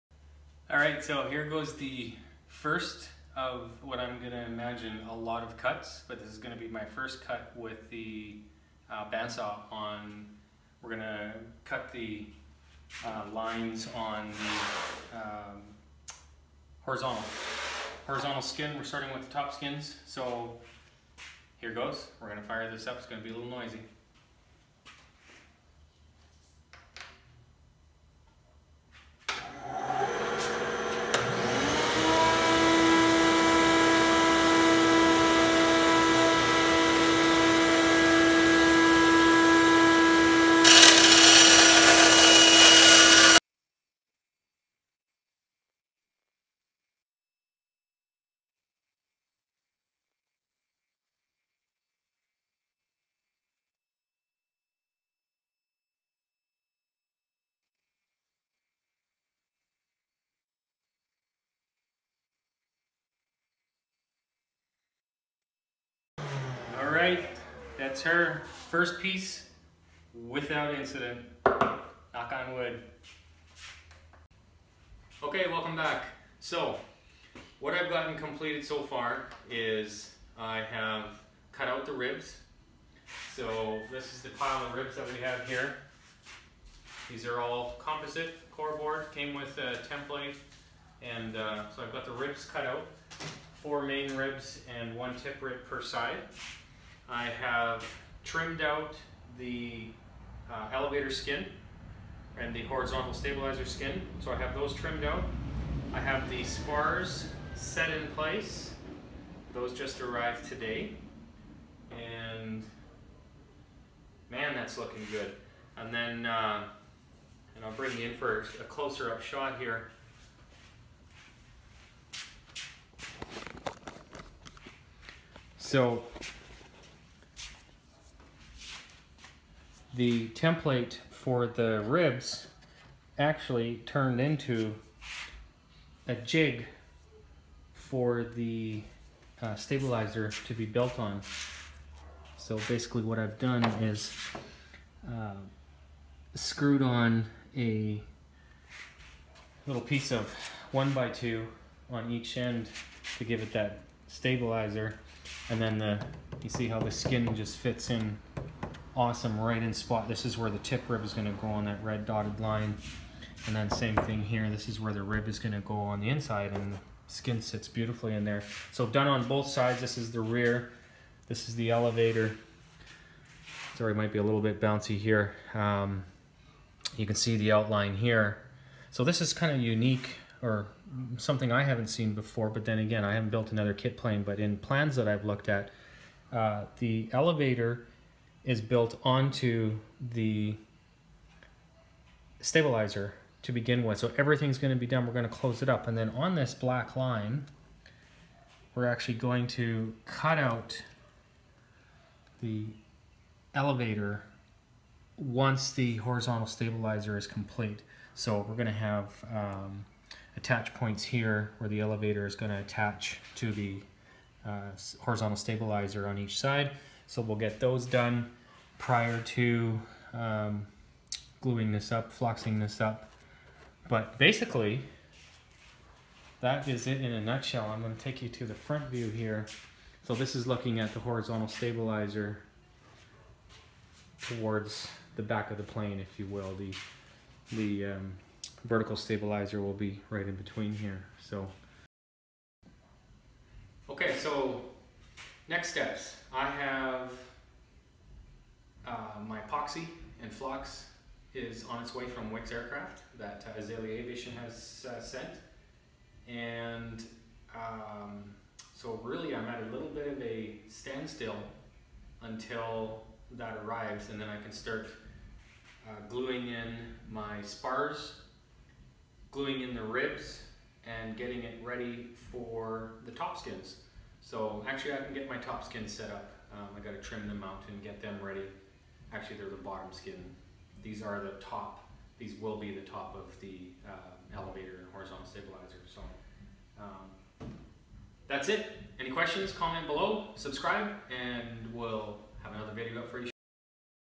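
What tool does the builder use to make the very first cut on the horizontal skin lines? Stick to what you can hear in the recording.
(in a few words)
Bandsaw.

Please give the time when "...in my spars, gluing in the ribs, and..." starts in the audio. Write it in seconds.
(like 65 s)
266 s.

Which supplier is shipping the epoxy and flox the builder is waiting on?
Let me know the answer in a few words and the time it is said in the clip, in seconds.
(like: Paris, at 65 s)
Wicks Aircraft, at 252 s.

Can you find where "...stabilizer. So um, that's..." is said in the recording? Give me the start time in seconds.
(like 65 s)
285 s.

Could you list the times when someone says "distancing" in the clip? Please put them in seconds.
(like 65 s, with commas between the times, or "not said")
not said.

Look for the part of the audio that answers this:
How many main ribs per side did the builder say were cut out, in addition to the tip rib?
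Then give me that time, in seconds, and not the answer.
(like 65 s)
93 s.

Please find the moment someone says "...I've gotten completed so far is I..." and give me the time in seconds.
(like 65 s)
77 s.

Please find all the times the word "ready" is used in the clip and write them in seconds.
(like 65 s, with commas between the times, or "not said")
271 s, 278 s.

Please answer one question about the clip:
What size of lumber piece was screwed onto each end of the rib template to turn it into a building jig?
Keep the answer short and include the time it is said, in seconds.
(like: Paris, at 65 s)
1 by 2, at 150 s.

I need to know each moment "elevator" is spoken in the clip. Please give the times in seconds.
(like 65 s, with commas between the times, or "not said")
100 s, 171 s, 187 s, 203 s, 211 s, 284 s.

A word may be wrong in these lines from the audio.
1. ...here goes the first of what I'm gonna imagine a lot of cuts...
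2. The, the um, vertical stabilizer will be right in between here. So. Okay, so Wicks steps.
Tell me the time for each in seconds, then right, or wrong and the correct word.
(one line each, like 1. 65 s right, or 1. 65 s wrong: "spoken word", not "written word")
1. 1 s right
2. 236 s wrong: "Next", not "Wicks".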